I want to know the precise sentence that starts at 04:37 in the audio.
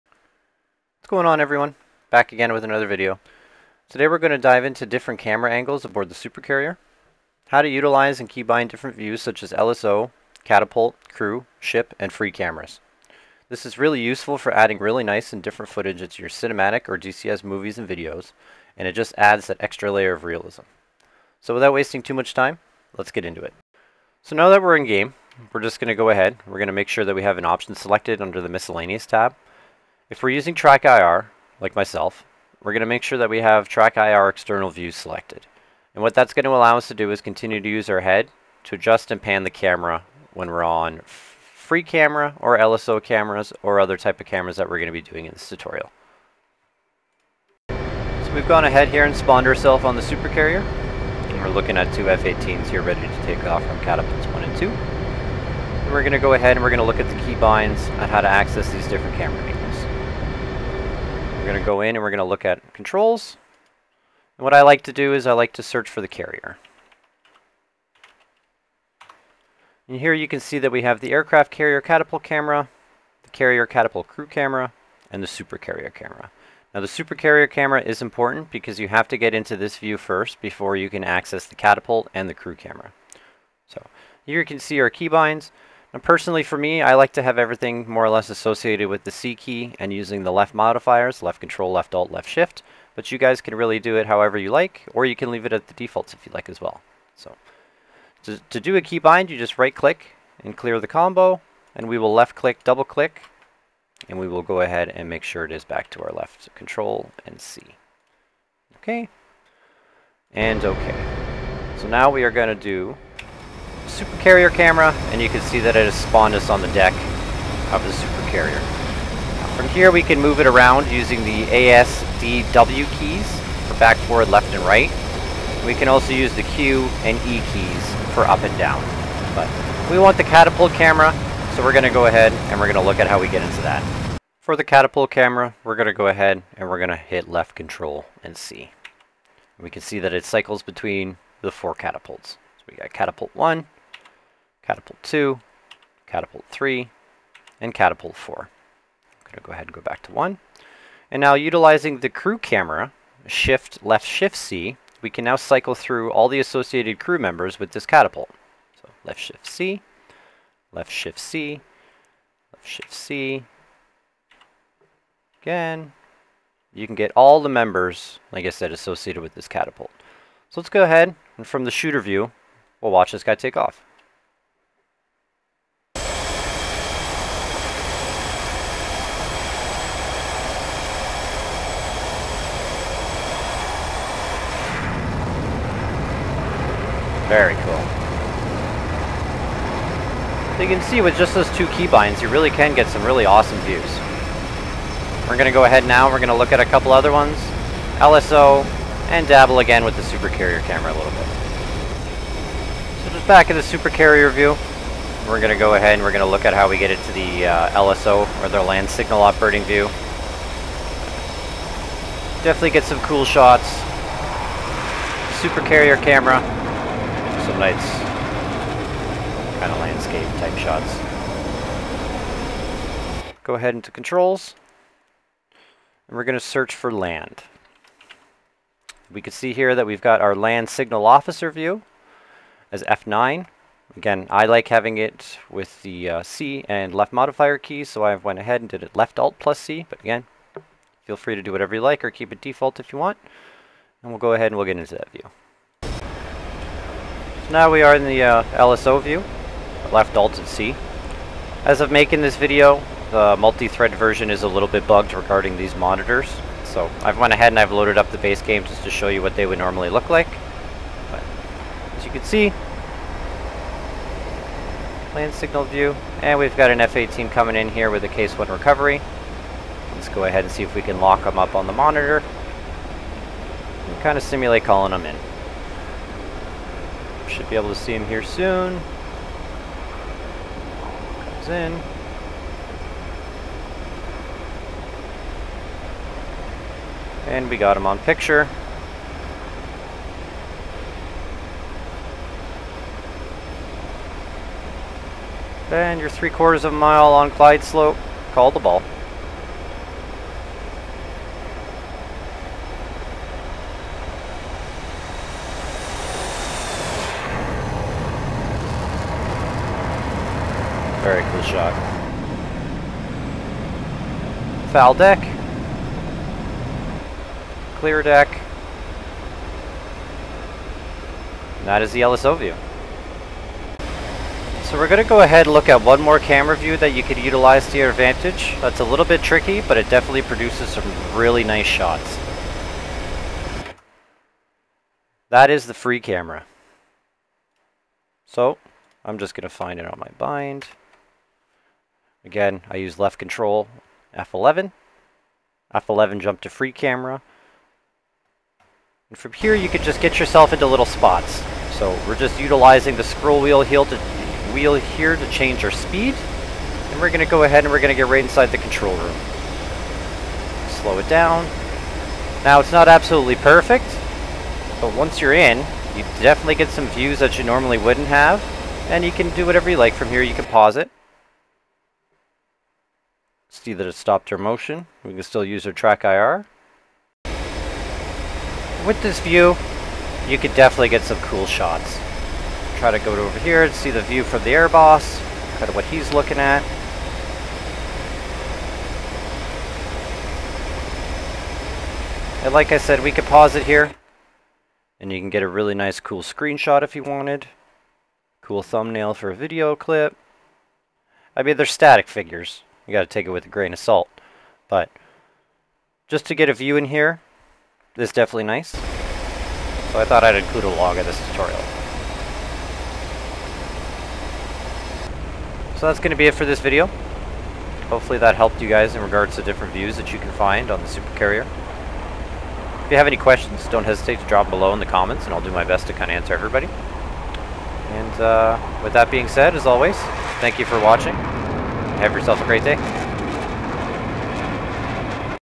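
Should be able to see him here soon.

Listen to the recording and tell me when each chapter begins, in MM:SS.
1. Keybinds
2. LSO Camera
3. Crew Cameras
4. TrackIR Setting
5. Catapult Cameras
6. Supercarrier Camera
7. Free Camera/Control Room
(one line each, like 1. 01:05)
1. 00:47
2. 03:22
3. 02:38
4. 00:22
5. 02:18
6. 01:50
7. 05:24.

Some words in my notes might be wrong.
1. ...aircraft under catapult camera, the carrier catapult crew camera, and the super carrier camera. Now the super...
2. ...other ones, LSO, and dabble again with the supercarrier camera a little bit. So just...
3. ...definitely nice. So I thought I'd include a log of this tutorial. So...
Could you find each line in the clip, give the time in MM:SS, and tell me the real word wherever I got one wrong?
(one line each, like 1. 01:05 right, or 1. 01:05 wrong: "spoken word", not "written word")
1. 01:11 wrong: "carrier", not "under"
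2. 03:16 right
3. 06:48 right.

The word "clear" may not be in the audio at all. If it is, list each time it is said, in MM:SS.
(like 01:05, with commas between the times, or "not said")
01:40, 05:17.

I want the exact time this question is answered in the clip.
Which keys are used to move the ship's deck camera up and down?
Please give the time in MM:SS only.
02:06.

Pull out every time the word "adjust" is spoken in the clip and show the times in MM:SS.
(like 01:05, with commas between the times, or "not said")
00:38.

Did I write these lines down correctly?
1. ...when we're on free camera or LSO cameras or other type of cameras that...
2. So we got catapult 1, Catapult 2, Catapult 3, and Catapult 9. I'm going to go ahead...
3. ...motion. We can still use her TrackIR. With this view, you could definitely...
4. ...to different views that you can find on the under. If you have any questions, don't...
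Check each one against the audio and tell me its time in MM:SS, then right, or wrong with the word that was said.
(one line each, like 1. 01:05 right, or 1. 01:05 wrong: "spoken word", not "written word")
1. 00:40 right
2. 02:22 wrong: "4", not "9"
3. 06:14 right
4. 06:59 wrong: "supercarrier", not "under".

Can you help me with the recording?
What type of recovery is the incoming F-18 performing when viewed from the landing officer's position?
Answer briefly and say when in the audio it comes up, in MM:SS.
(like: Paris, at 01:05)
Case one, at 04:28.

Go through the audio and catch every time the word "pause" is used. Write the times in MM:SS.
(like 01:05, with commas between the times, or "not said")
06:10, 06:33.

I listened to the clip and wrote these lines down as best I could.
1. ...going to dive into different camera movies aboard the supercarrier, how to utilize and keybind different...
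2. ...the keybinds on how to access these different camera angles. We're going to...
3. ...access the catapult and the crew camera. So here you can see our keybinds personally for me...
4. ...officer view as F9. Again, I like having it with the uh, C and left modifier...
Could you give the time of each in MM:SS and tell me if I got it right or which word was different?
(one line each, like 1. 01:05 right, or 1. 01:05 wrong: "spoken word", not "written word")
1. 00:04 wrong: "angles", not "movies"
2. 00:57 right
3. 01:21 right
4. 03:51 right.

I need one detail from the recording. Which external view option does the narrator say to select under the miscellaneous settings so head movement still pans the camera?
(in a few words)
TrackIR external view.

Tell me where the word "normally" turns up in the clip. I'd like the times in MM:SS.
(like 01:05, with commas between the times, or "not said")
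04:19, 06:07.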